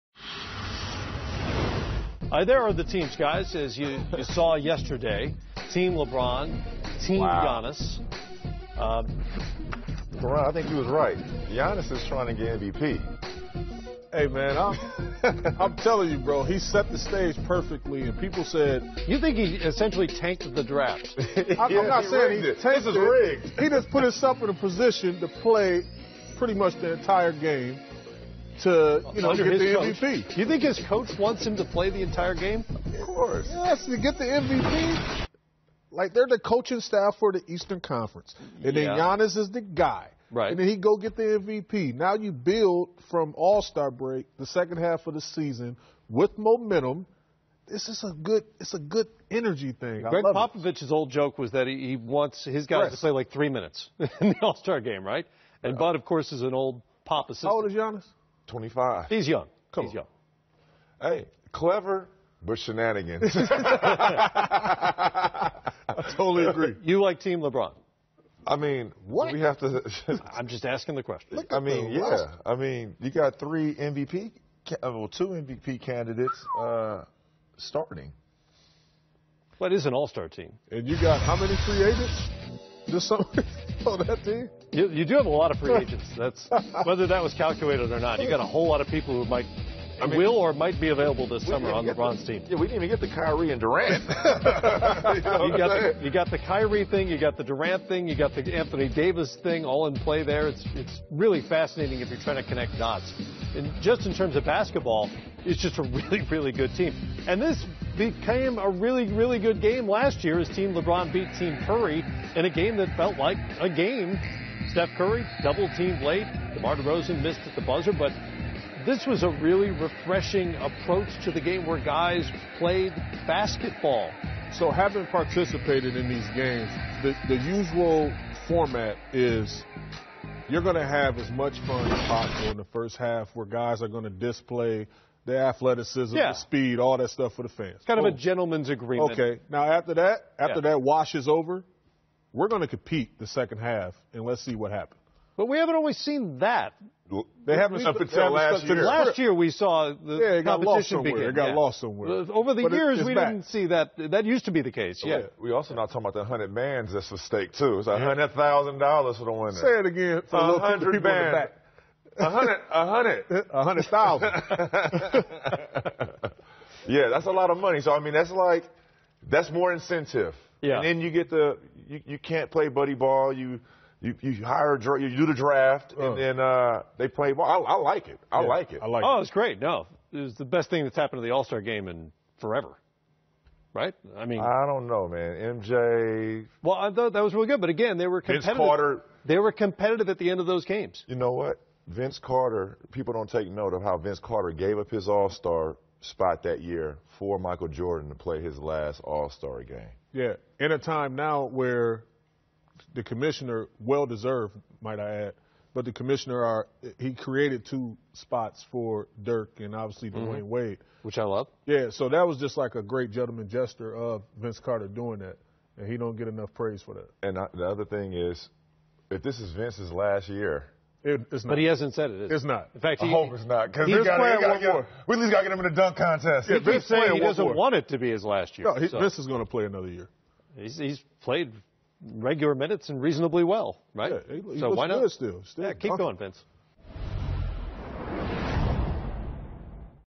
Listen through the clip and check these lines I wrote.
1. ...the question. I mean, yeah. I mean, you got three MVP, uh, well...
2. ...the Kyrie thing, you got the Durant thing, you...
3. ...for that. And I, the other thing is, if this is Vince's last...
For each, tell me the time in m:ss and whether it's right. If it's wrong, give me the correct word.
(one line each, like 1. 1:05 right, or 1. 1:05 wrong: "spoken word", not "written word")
1. 1:10 right
2. 1:36 right
3. 3:36 right.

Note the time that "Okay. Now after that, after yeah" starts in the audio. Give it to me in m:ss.
2:19.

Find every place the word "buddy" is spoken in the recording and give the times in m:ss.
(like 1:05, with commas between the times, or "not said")
2:52.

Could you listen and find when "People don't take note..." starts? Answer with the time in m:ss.
3:12.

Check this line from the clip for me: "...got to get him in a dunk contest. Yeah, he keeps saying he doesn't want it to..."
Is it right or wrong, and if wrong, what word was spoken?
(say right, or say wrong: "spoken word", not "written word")
right.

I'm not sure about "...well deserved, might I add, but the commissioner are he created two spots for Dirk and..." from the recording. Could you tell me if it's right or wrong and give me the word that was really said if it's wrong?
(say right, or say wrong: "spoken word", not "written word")
right.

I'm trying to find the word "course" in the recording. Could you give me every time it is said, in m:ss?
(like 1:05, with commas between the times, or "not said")
0:33, 0:56.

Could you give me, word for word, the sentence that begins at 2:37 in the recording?
It's a hundred thousand dollars for the winner.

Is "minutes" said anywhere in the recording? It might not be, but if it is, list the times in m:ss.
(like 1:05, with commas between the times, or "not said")
0:53, 3:52.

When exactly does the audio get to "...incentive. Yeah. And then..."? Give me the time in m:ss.
2:49.